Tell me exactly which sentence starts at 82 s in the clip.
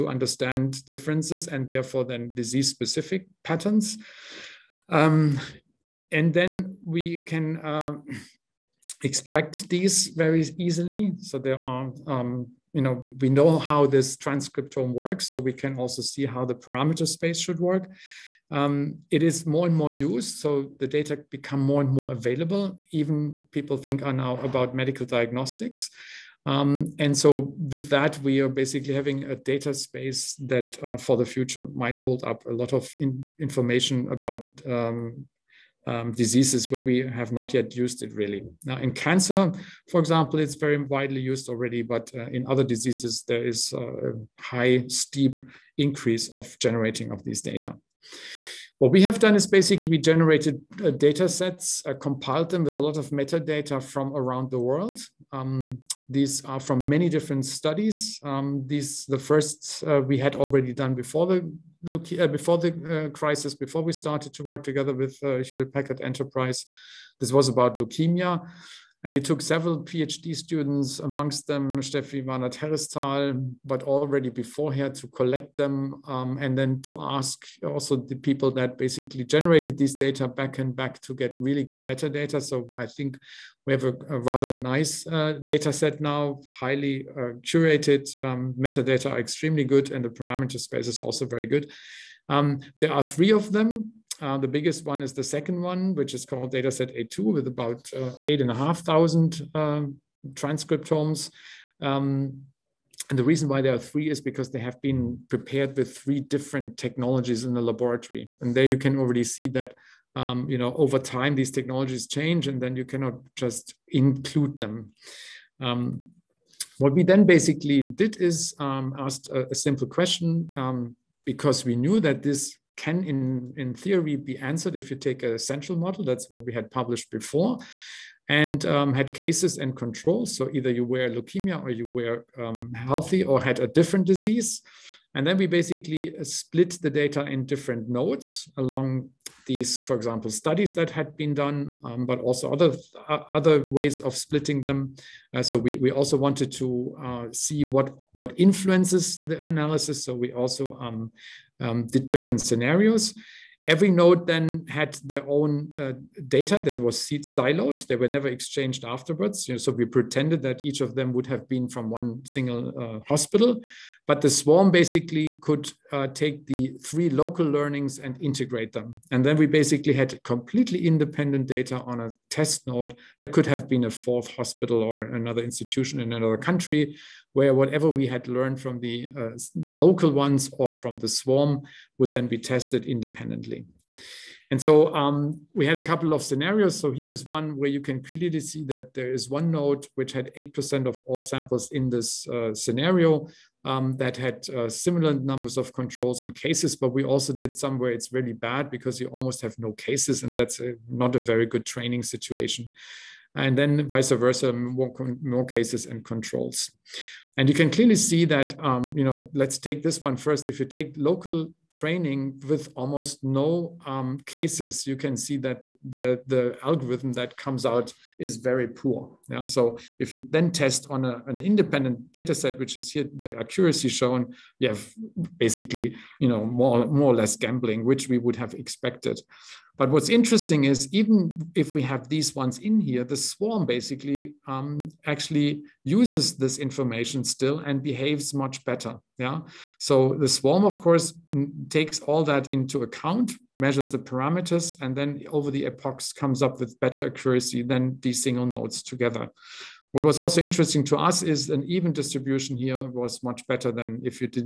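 So I think we have a, a rather nice uh, data set now, highly uh, curated.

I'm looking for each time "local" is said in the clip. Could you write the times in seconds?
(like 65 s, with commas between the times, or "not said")
167 s, 179 s, 210 s.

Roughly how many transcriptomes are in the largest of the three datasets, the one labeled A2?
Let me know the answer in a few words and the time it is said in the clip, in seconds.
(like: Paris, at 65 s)
8,500, at 98 s.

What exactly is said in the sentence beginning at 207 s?
And you can clearly see that, um, you know, let's take this one first.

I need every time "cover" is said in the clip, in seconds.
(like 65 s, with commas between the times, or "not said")
not said.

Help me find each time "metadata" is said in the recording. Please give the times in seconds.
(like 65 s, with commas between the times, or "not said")
53 s, 81 s, 88 s.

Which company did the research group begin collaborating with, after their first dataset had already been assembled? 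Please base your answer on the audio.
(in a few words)
Hewlett Packard Enterprise.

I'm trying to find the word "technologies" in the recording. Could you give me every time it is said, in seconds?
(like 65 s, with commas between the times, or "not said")
106 s, 111 s.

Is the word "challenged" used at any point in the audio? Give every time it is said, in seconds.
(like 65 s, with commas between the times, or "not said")
not said.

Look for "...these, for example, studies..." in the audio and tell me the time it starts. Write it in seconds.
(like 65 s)
139 s.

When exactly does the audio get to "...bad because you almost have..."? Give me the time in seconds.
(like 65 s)
198 s.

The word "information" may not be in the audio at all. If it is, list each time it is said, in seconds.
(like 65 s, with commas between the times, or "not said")
33 s, 236 s.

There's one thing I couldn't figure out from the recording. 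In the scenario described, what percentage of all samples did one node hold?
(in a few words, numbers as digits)
8%.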